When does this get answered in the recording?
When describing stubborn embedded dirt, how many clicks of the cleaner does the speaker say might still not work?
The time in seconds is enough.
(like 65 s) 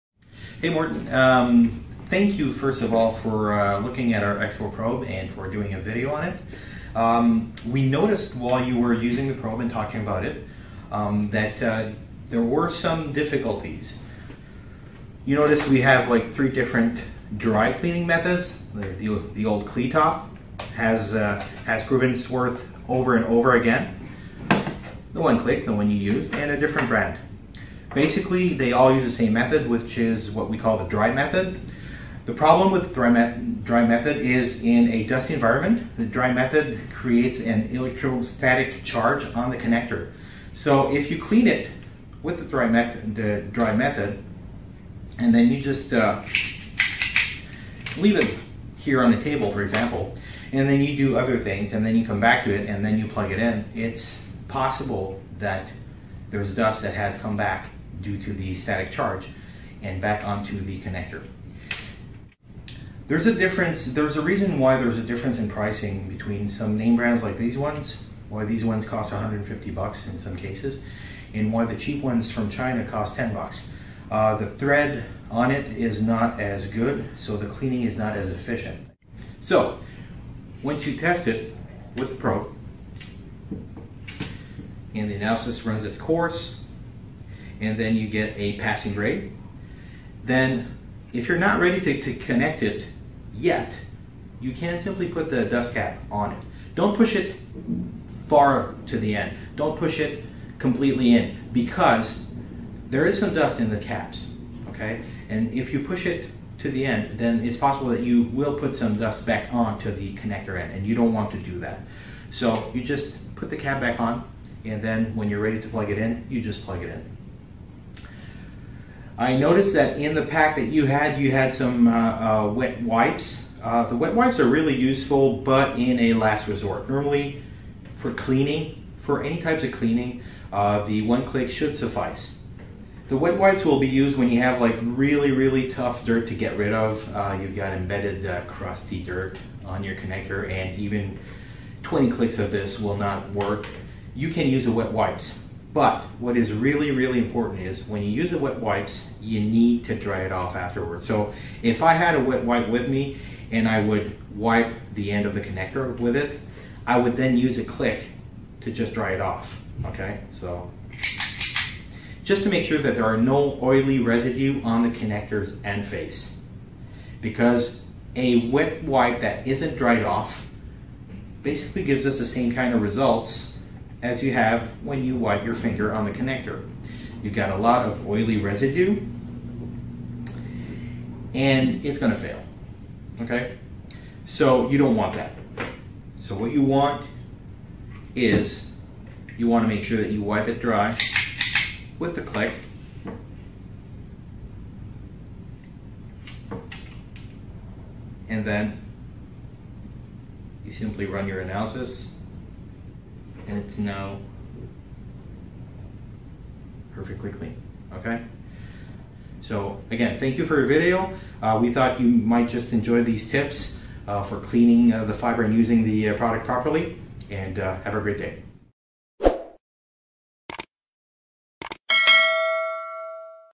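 141 s.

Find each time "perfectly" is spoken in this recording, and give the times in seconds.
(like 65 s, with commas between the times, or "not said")
206 s.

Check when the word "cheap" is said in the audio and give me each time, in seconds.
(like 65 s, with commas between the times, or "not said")
71 s.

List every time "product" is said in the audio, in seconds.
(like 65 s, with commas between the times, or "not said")
216 s.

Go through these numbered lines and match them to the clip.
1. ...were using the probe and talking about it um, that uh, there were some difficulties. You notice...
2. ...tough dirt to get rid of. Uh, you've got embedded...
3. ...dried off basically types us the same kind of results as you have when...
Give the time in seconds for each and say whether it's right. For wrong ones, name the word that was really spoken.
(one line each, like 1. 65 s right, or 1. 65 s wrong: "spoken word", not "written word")
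1. 8 s right
2. 135 s right
3. 169 s wrong: "gives", not "types".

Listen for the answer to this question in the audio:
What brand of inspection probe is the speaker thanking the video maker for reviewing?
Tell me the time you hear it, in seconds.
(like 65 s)
4 s.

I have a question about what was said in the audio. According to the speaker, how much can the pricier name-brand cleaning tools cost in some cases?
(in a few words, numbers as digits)
$150.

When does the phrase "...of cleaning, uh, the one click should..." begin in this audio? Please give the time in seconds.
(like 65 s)
129 s.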